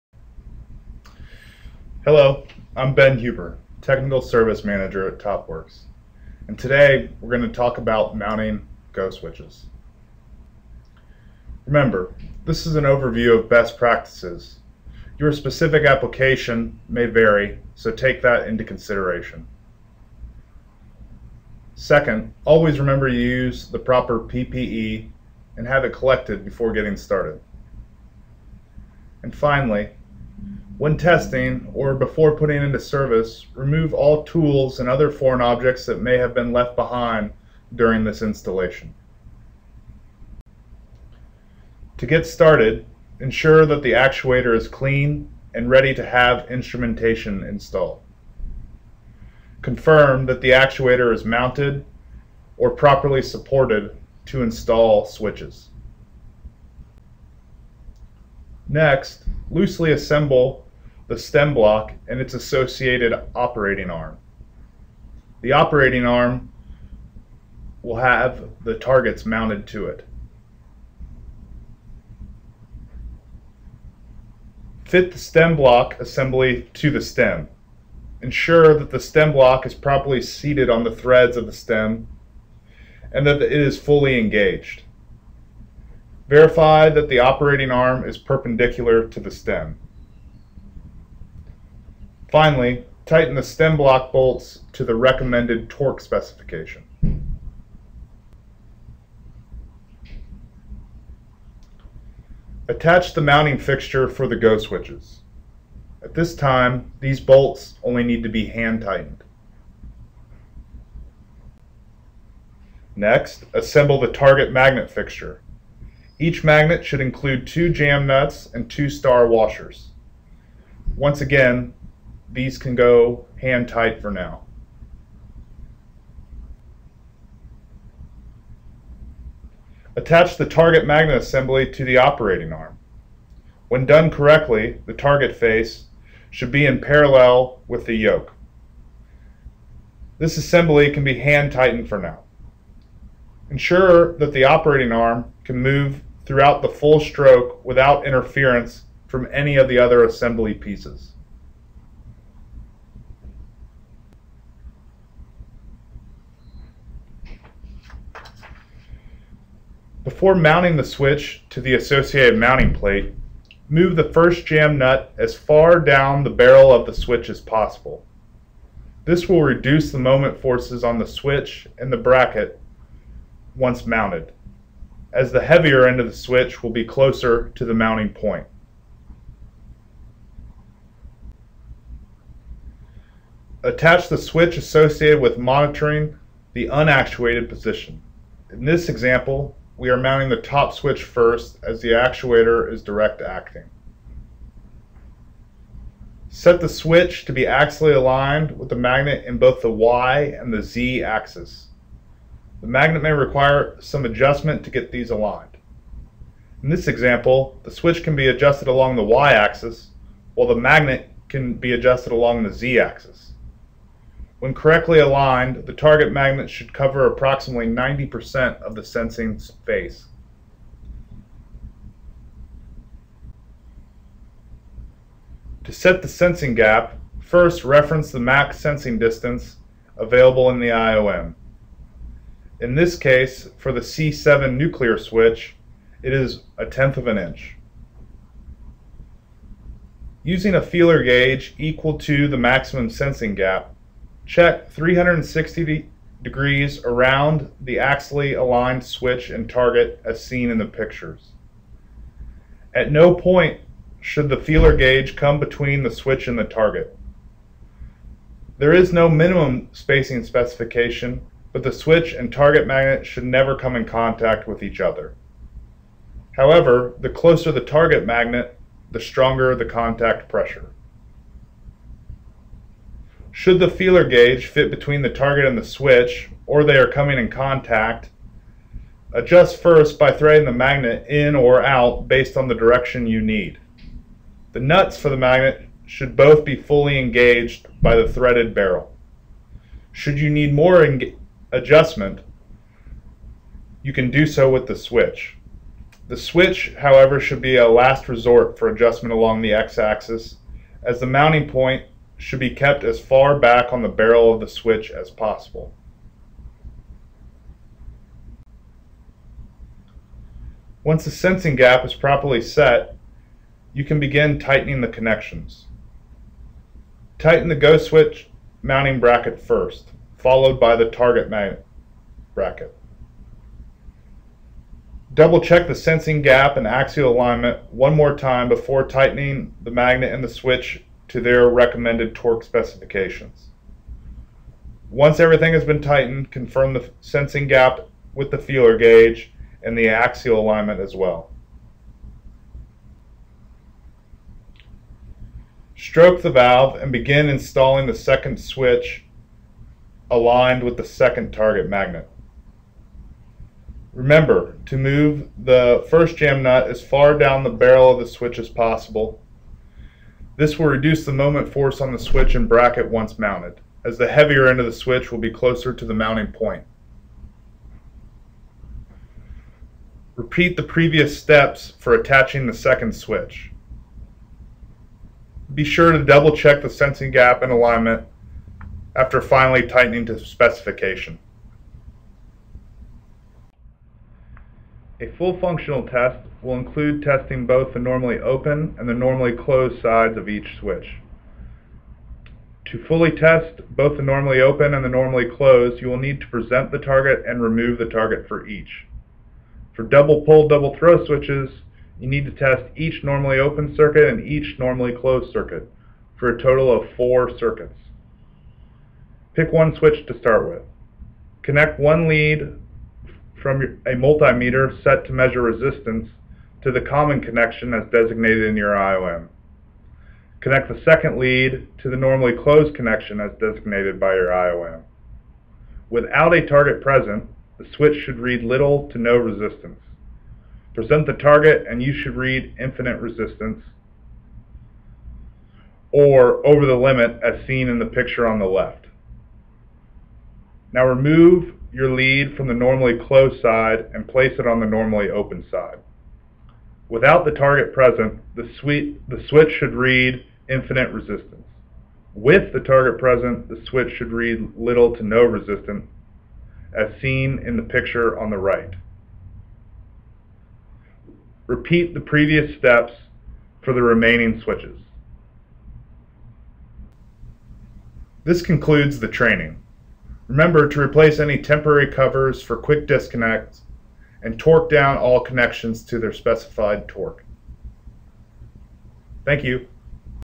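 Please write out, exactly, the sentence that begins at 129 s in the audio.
Attach the target magnet assembly to the operating arm.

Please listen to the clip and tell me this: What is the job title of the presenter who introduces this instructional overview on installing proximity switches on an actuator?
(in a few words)
Technical Service Manager.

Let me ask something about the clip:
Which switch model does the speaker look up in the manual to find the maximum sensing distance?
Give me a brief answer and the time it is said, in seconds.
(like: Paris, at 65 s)
C7, at 233 s.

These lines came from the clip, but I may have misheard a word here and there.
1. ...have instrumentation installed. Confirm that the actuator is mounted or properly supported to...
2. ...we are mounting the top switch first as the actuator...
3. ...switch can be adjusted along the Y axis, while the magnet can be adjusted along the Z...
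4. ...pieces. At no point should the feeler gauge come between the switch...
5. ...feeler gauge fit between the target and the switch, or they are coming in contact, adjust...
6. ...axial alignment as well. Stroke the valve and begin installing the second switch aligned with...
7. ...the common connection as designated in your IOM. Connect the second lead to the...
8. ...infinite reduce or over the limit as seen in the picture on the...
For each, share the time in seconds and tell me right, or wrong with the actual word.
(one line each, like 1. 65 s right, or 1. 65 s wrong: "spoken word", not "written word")
1. 46 s right
2. 189 s right
3. 207 s right
4. 250 s wrong: "pictures", not "pieces"
5. 273 s right
6. 339 s right
7. 416 s right
8. 432 s wrong: "resistance", not "reduce".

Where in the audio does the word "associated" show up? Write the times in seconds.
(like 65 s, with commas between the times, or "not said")
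62 s, 161 s, 184 s.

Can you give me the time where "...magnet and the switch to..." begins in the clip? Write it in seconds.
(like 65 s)
329 s.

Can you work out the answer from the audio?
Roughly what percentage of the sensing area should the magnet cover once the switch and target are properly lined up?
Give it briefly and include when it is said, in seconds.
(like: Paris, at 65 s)
90%, at 217 s.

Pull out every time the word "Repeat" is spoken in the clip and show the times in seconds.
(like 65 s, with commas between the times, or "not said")
370 s, 461 s.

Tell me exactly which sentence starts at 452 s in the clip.
With the target present, the switch should read little to no resistance, as seen in the picture on the right.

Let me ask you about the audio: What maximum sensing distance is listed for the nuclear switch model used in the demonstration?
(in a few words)
A tenth of an inch.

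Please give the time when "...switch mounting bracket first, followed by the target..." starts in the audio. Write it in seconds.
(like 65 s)
317 s.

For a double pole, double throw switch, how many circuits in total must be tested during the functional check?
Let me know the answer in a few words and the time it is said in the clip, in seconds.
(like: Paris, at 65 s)
4, at 406 s.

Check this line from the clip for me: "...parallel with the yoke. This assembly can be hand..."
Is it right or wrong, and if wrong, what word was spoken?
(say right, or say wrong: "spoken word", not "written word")
right.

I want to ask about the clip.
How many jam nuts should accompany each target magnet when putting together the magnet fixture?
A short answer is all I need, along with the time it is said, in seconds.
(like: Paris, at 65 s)
2, at 117 s.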